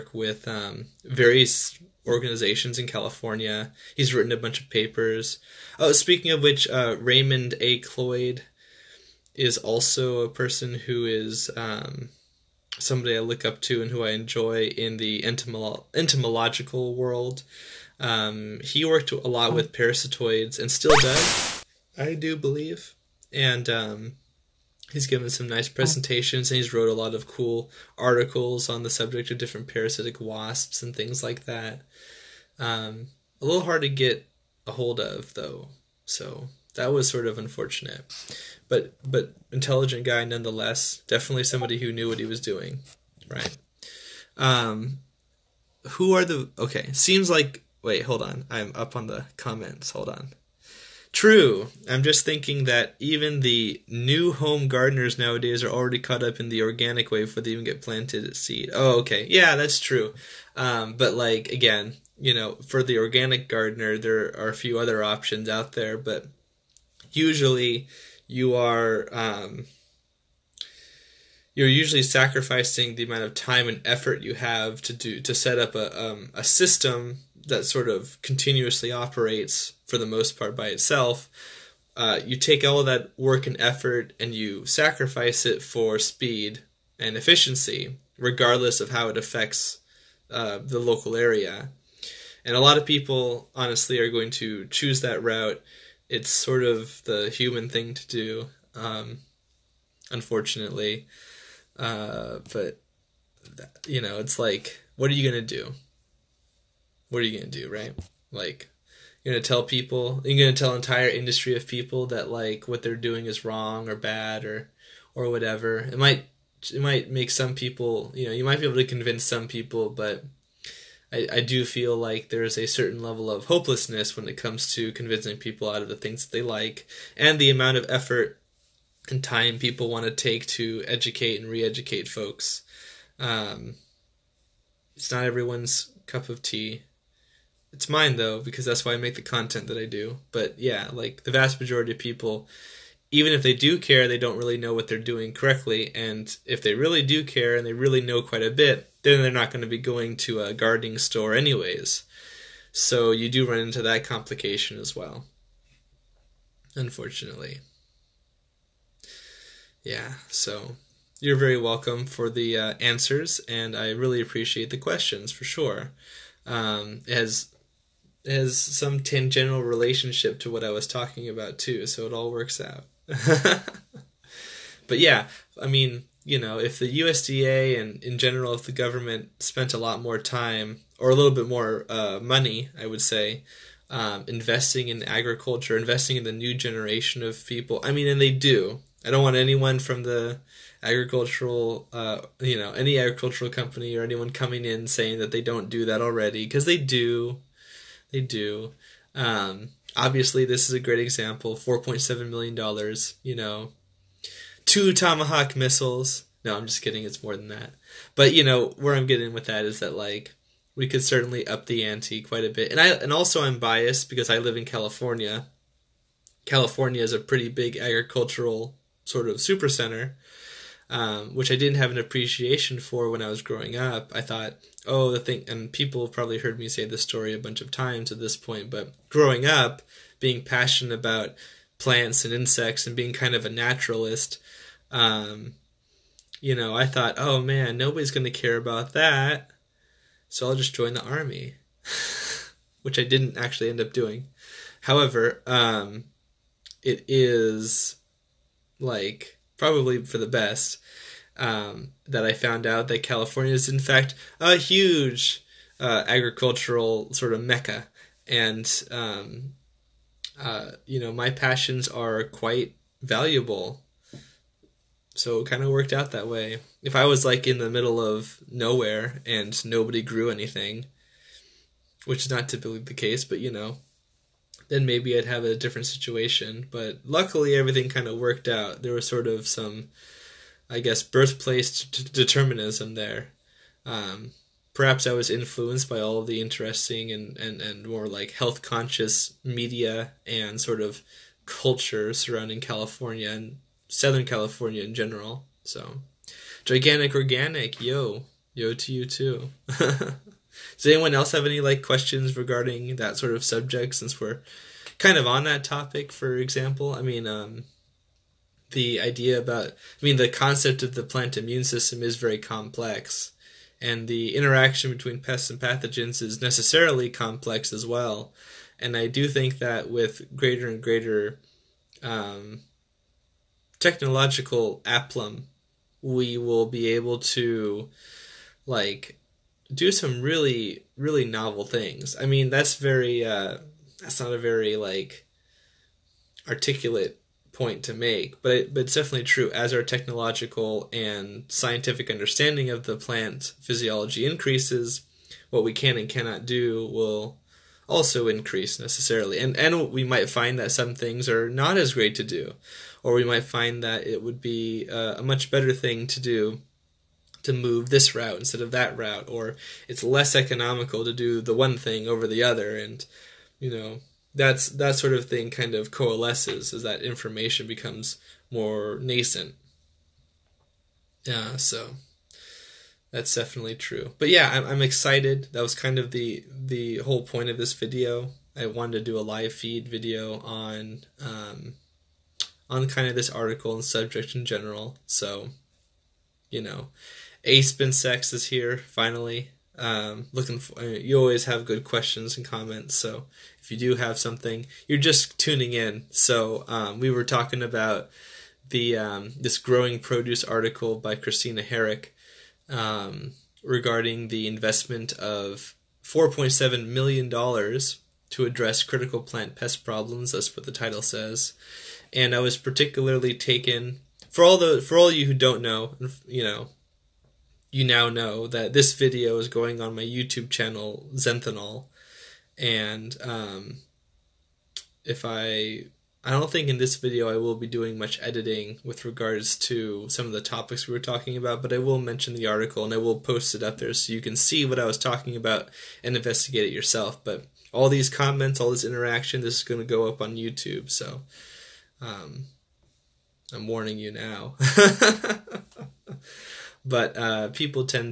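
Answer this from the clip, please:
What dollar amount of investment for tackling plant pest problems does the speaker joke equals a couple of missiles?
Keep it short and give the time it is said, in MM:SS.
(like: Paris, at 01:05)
$4.7 million, at 03:21.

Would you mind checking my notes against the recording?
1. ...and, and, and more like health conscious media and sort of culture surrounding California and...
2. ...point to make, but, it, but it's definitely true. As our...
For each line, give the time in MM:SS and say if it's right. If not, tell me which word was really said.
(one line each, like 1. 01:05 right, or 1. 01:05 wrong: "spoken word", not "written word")
1. 04:47 right
2. 05:37 right.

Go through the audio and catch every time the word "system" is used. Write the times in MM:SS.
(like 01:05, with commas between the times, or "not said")
01:16, 05:11.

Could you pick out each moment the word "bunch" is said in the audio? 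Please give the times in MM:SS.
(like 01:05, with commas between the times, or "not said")
00:04, 03:47.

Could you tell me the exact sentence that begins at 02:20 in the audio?
But yeah, like the vast majority of people even if they do care, they don't really know what they're doing correctly.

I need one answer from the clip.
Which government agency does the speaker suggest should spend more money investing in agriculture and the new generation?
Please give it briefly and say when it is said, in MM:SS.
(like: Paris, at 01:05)
USDA, at 02:56.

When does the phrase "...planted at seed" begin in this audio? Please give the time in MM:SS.
00:57.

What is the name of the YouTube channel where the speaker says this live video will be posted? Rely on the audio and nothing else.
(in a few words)
Zenthanol.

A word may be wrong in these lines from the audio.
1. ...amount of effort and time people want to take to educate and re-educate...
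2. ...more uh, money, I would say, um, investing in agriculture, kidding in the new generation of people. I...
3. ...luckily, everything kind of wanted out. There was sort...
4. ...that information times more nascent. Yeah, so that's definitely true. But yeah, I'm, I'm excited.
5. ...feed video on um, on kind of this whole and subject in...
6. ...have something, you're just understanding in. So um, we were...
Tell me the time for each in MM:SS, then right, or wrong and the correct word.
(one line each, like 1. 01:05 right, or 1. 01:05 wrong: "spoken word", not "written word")
1. 02:07 right
2. 03:01 wrong: "investing", not "kidding"
3. 04:37 wrong: "worked", not "wanted"
4. 06:06 wrong: "becomes", not "times"
5. 06:19 wrong: "article", not "whole"
6. 06:33 wrong: "tuning", not "understanding".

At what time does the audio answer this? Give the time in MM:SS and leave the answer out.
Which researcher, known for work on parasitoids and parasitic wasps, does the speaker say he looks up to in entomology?
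00:06.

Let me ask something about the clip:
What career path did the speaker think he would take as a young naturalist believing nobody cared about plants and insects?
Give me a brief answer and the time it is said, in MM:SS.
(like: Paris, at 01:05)
join the army, at 04:00.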